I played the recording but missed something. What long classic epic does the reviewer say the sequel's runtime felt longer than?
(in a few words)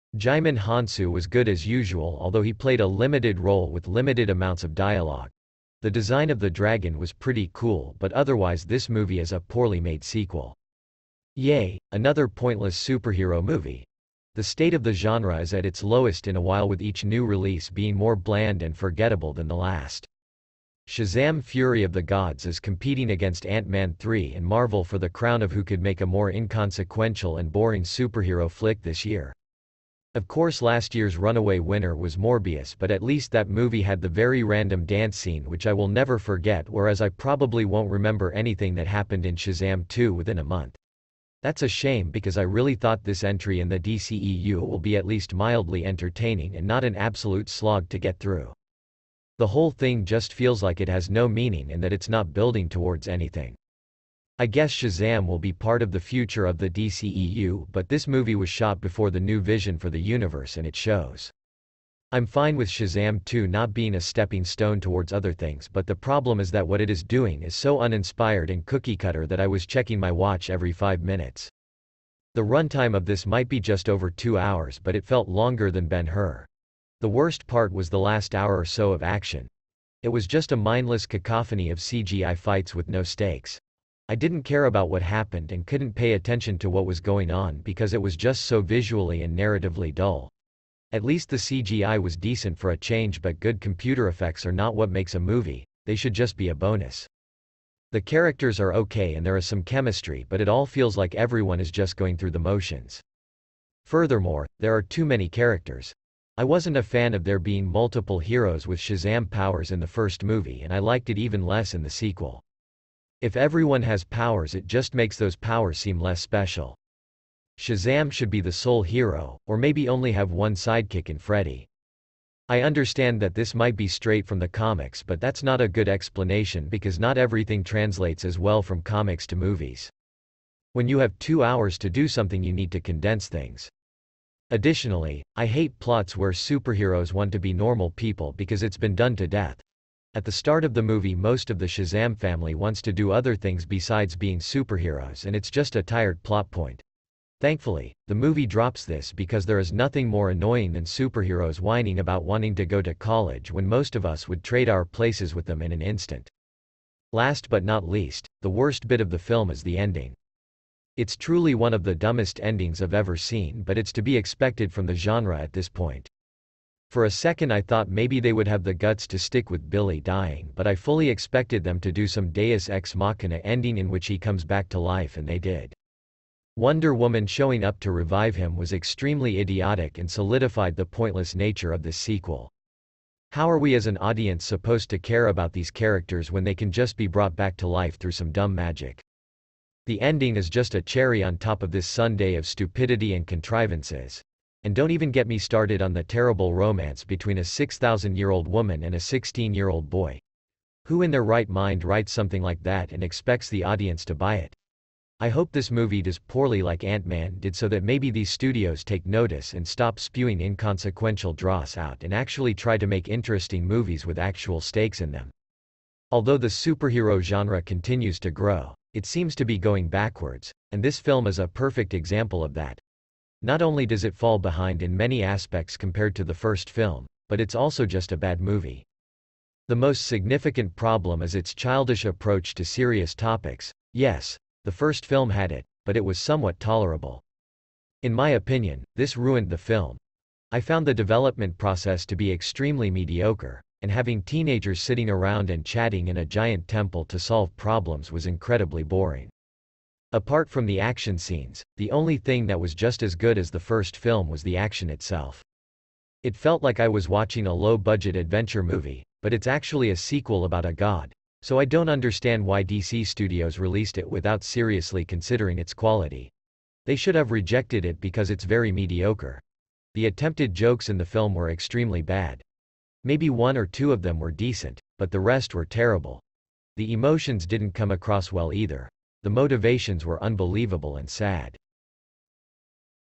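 Ben-Hur.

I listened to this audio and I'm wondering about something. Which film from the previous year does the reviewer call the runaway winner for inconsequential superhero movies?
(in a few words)
Morbius.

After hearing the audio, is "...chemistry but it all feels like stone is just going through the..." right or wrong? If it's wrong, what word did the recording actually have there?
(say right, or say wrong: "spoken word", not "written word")
wrong: "everyone", not "stone".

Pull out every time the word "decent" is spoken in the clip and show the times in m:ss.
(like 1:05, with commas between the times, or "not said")
1:32, 4:34.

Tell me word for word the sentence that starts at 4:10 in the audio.
Apart from the action scenes, the only thing that was just as good as the first film was the action itself.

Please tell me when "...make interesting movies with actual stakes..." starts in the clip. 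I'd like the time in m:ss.
3:32.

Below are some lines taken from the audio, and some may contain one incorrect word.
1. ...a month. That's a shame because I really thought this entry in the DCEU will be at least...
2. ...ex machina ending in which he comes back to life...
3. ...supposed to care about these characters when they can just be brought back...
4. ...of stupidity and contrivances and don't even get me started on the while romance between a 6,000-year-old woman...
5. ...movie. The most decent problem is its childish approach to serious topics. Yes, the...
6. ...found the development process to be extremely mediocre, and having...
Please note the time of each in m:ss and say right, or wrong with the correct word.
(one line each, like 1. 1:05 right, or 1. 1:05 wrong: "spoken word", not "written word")
1. 0:40 right
2. 2:52 right
3. 3:04 right
4. 3:12 wrong: "terrible", not "while"
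5. 3:48 wrong: "significant", not "decent"
6. 4:00 right.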